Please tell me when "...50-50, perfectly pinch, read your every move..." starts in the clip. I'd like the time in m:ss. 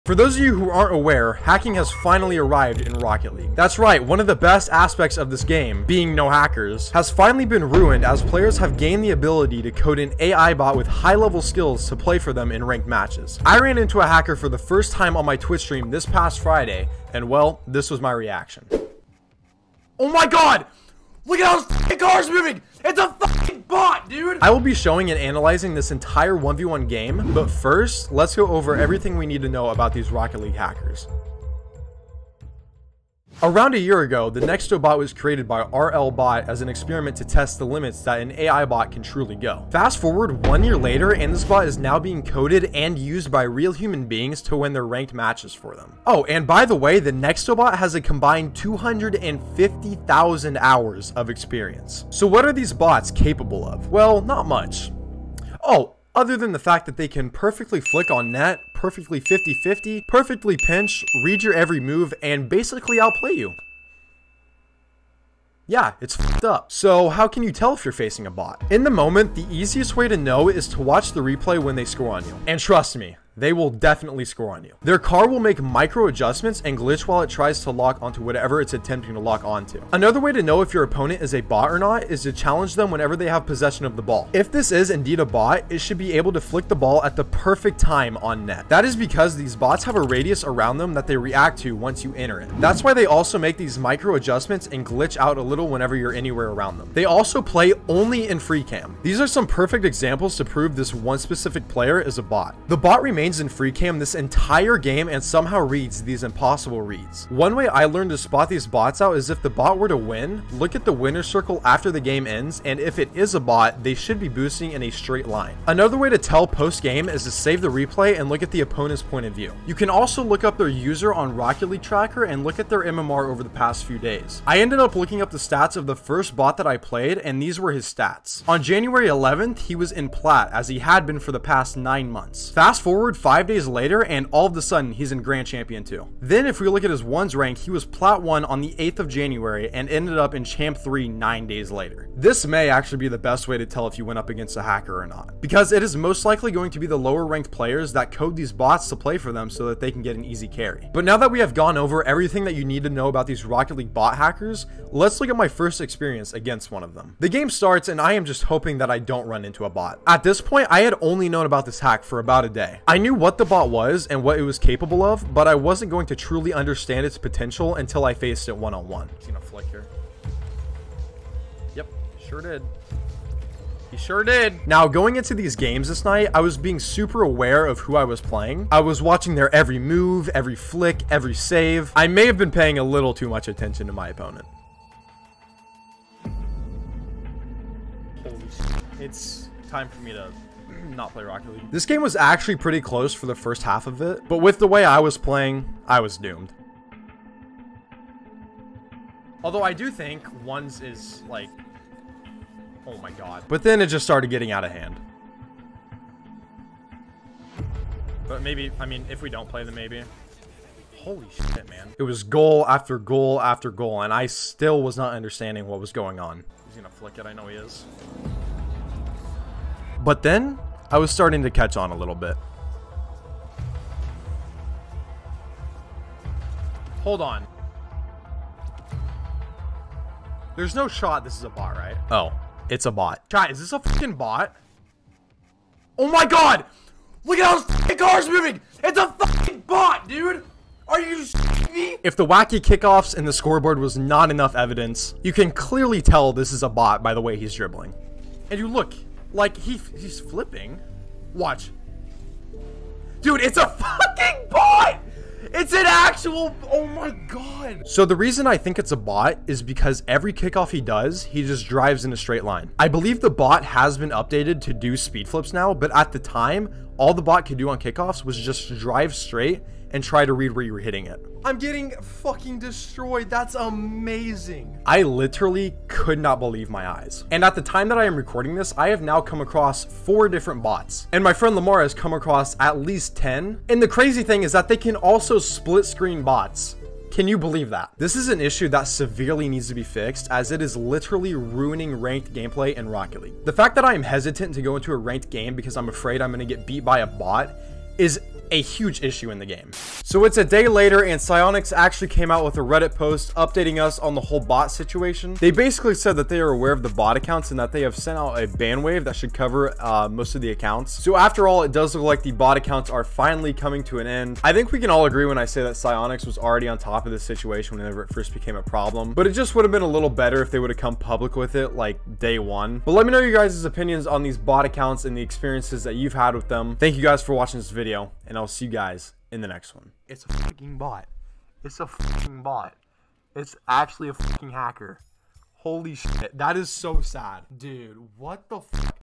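0:59.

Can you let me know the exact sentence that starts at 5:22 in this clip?
But let me know your guys' opinions on these bot accounts and the experiences that you've had with them.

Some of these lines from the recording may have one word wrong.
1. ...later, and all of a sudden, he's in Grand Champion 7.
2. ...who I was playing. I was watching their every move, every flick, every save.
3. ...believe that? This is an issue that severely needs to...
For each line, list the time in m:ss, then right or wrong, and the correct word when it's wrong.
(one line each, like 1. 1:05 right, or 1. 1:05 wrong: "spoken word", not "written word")
1. 2:13 wrong: "2", not "7"
2. 2:57 right
3. 4:47 right.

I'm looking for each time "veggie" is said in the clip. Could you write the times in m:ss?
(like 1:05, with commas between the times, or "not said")
not said.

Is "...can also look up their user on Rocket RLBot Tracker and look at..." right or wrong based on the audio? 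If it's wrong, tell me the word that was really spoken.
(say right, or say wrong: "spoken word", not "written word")
wrong: "League", not "RLBot".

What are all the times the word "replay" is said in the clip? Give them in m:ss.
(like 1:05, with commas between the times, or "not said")
1:11, 1:57.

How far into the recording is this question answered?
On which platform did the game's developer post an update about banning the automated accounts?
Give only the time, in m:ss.
5:02.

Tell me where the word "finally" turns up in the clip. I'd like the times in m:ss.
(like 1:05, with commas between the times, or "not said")
0:02, 0:07, 5:13.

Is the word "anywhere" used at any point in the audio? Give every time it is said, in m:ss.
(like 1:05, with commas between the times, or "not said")
1:36.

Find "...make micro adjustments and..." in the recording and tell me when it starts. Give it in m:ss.
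1:15.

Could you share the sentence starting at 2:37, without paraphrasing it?
The game starts and I am just hoping that I don't run into a bot.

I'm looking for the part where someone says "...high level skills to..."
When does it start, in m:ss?
0:10.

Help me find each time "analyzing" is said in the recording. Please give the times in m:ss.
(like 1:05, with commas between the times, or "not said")
0:25.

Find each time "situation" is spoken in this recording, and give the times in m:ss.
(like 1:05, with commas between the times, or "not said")
5:04, 5:17.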